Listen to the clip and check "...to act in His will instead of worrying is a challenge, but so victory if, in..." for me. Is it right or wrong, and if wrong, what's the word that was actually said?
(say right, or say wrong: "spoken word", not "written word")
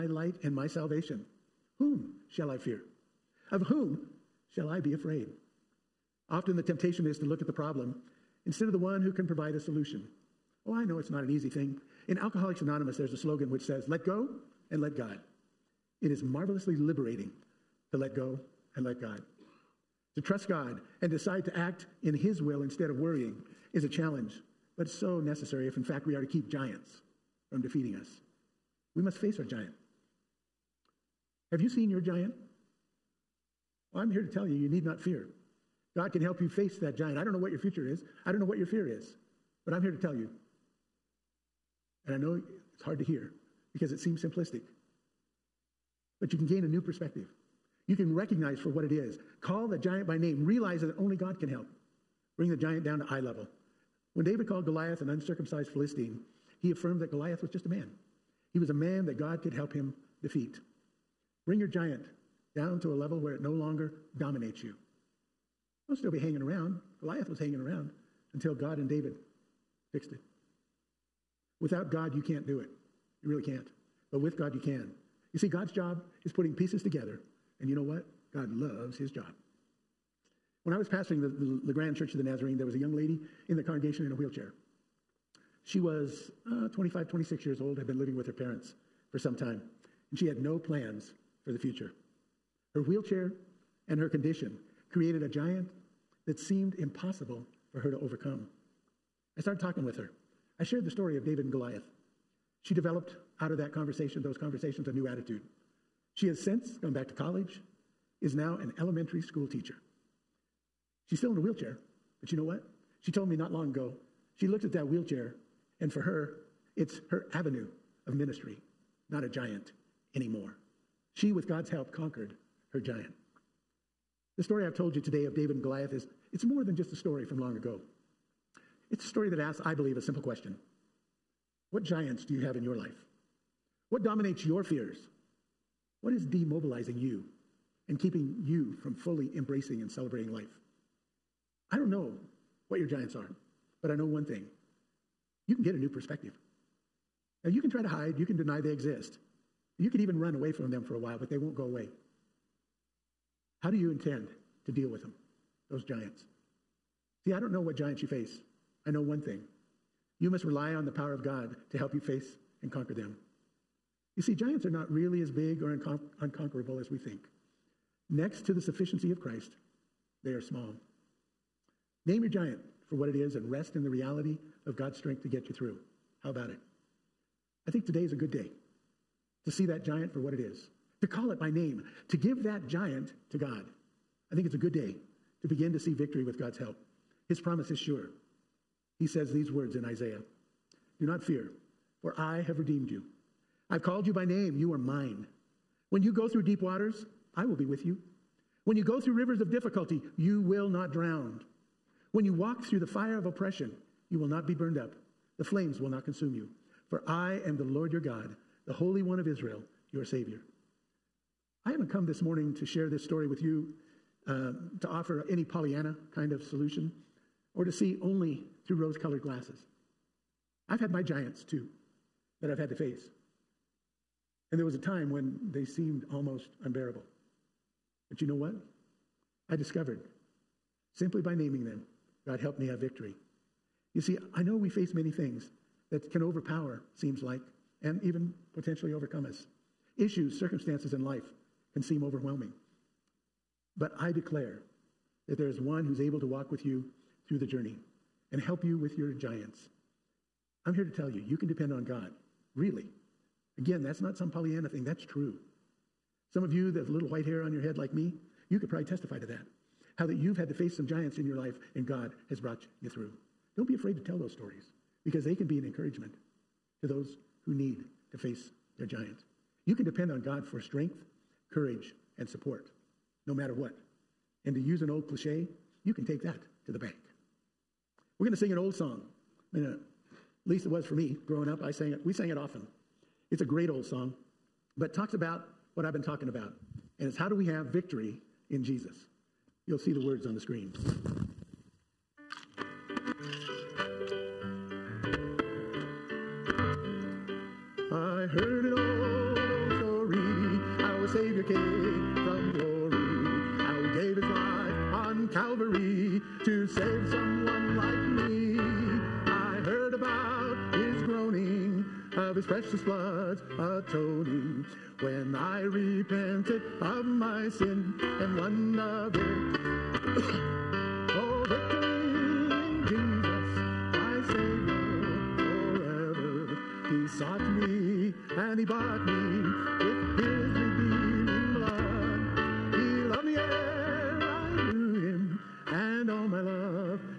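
wrong: "necessary", not "victory".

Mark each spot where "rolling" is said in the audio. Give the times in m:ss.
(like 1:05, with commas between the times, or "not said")
not said.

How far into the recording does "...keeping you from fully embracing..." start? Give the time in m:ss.
2:17.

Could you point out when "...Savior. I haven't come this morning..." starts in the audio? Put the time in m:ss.
3:30.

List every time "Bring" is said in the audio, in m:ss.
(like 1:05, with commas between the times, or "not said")
0:52, 1:01.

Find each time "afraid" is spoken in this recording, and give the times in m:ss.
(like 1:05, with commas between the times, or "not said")
0:04, 4:23.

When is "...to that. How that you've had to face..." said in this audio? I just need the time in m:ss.
4:19.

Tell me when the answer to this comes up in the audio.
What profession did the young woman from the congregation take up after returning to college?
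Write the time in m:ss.
1:48.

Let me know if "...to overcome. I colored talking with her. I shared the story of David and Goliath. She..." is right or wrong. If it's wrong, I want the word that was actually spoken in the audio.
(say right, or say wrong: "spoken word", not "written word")
wrong: "started", not "colored".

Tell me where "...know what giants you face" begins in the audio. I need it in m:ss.
2:37.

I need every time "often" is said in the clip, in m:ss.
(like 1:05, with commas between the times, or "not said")
0:06, 4:42.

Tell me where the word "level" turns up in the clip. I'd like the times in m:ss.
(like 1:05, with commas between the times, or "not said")
0:53, 1:02.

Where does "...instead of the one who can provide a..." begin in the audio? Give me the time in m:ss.
0:08.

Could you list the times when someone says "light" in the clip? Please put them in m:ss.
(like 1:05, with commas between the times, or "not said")
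0:00.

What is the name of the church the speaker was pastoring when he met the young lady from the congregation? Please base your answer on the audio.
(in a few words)
Grand Church of the Nazarene.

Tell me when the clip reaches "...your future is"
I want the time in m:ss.
0:37.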